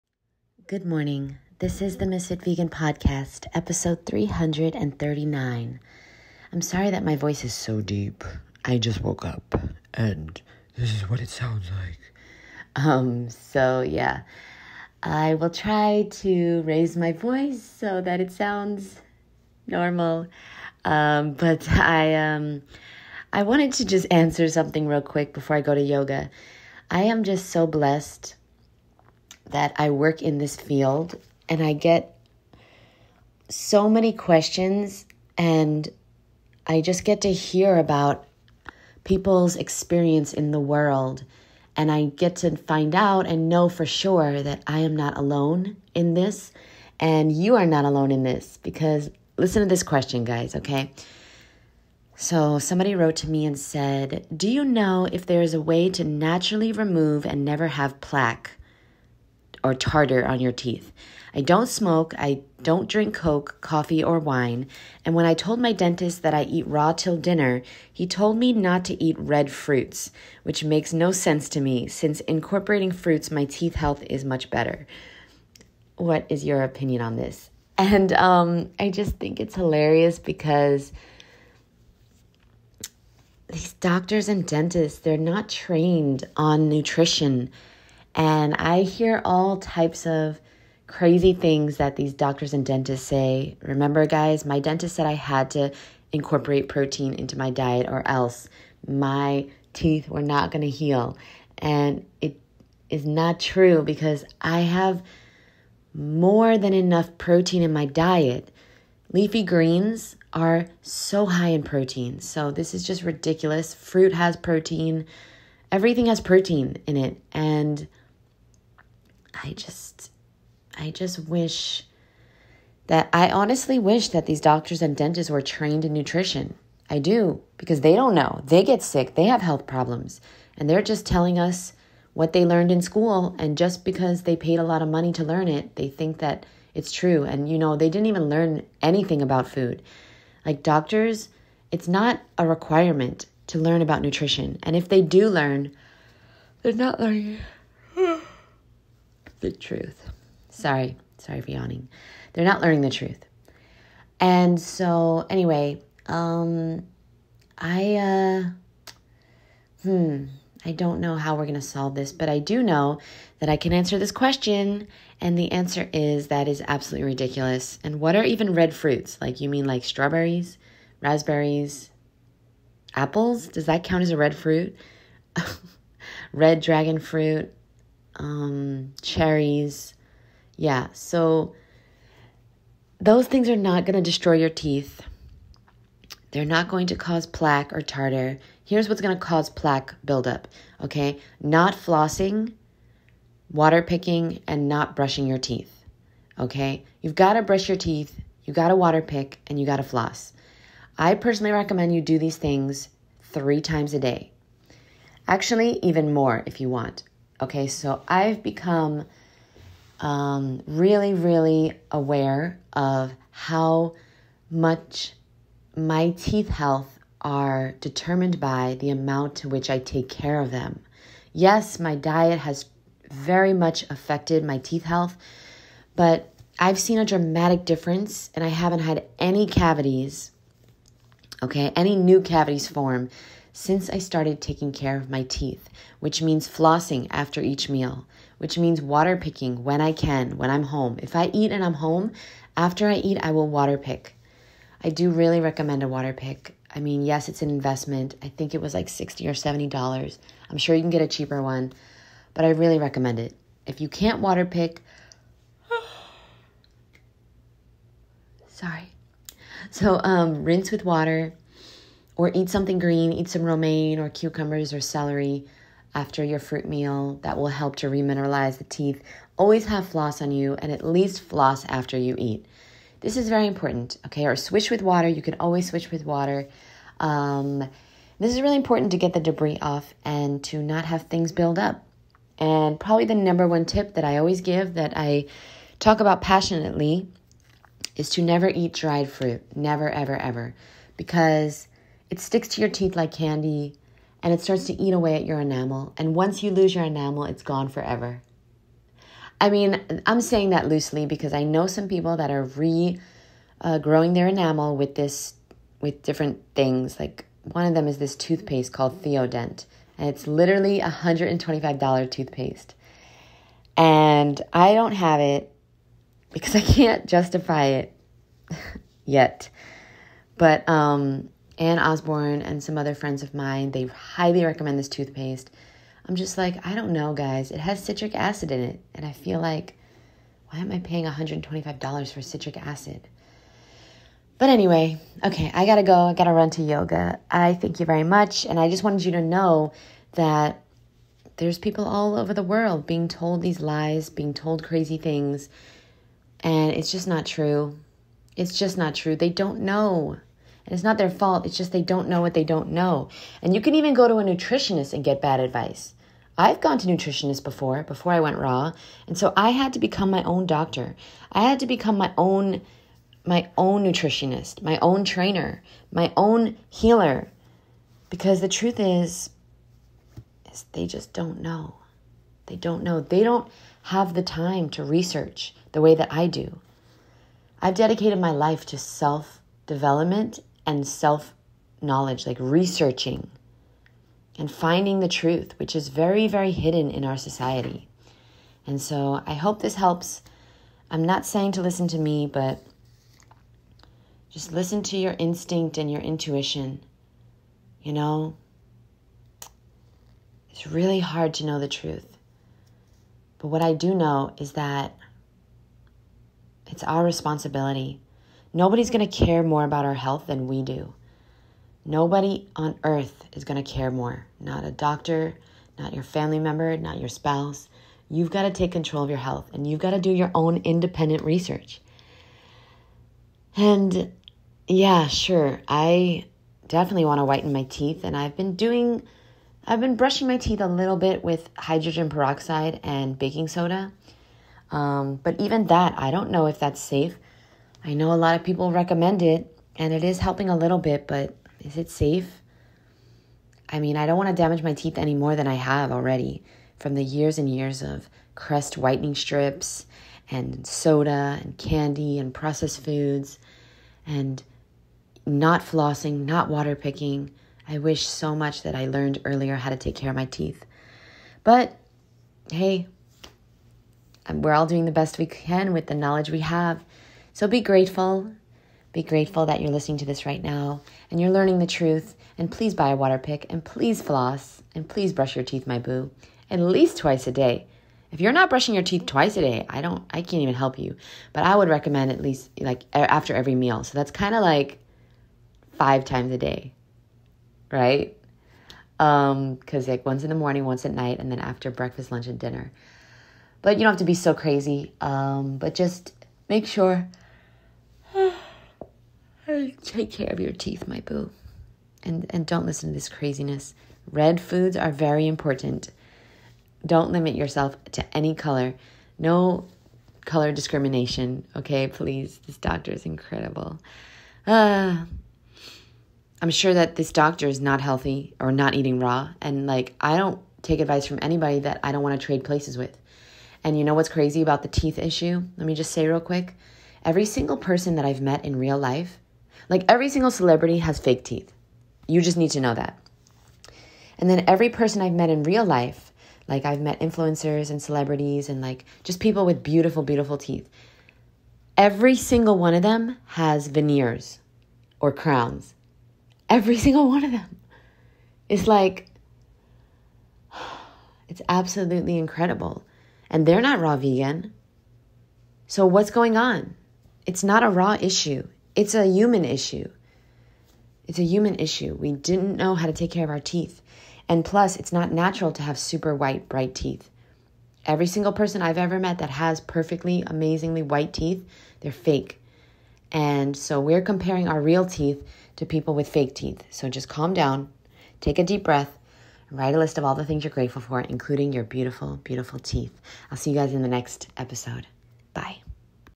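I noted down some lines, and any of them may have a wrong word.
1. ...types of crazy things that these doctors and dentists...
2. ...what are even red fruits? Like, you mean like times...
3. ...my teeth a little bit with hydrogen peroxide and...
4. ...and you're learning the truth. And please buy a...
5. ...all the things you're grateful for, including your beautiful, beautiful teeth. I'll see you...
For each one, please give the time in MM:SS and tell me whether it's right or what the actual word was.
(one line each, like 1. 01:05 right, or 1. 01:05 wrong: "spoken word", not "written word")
1. 01:29 right
2. 02:47 wrong: "strawberries", not "times"
3. 07:10 right
4. 07:51 right
5. 09:40 right.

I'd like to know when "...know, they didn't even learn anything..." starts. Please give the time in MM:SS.
02:17.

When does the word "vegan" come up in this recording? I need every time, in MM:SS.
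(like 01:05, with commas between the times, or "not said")
00:02, 09:13.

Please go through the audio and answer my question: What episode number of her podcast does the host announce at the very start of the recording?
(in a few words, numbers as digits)
339.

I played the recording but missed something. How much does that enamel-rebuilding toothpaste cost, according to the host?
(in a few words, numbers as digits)
$125.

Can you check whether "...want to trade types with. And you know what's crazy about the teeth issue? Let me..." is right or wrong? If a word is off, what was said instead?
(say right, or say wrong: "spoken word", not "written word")
wrong: "places", not "types".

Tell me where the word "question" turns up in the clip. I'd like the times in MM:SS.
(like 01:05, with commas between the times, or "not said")
00:34, 00:49, 02:44.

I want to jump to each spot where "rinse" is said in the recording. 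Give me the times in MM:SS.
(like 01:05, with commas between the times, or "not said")
04:20.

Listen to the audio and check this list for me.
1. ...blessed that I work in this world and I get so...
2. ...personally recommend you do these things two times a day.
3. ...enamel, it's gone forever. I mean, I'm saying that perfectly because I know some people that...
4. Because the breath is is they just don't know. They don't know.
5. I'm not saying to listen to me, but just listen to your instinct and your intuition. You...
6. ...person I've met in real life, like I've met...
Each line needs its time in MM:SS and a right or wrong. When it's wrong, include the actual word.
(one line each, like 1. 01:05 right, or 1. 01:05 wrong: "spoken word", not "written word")
1. 00:27 wrong: "field", not "world"
2. 03:21 wrong: "three", not "two"
3. 04:56 wrong: "loosely", not "perfectly"
4. 06:08 wrong: "truth", not "breath"
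5. 06:30 right
6. 08:54 right.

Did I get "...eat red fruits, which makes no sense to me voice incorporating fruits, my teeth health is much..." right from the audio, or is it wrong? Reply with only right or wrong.
wrong.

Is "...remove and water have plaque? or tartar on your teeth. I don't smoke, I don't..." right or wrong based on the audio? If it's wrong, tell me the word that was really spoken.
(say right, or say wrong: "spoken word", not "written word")
wrong: "never", not "water".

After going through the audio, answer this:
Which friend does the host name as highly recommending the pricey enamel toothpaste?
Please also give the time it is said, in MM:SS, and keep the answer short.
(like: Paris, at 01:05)
Anne Osborne, at 05:21.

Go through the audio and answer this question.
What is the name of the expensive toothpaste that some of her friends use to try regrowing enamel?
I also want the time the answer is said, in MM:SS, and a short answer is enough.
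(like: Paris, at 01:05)
Theodent, at 05:09.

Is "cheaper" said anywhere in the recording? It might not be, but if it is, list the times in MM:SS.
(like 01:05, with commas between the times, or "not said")
04:11.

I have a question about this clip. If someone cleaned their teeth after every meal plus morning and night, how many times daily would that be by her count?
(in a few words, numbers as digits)
5.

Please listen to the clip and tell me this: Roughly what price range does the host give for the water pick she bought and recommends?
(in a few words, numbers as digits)
$60 or $70.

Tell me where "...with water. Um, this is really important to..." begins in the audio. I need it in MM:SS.
04:35.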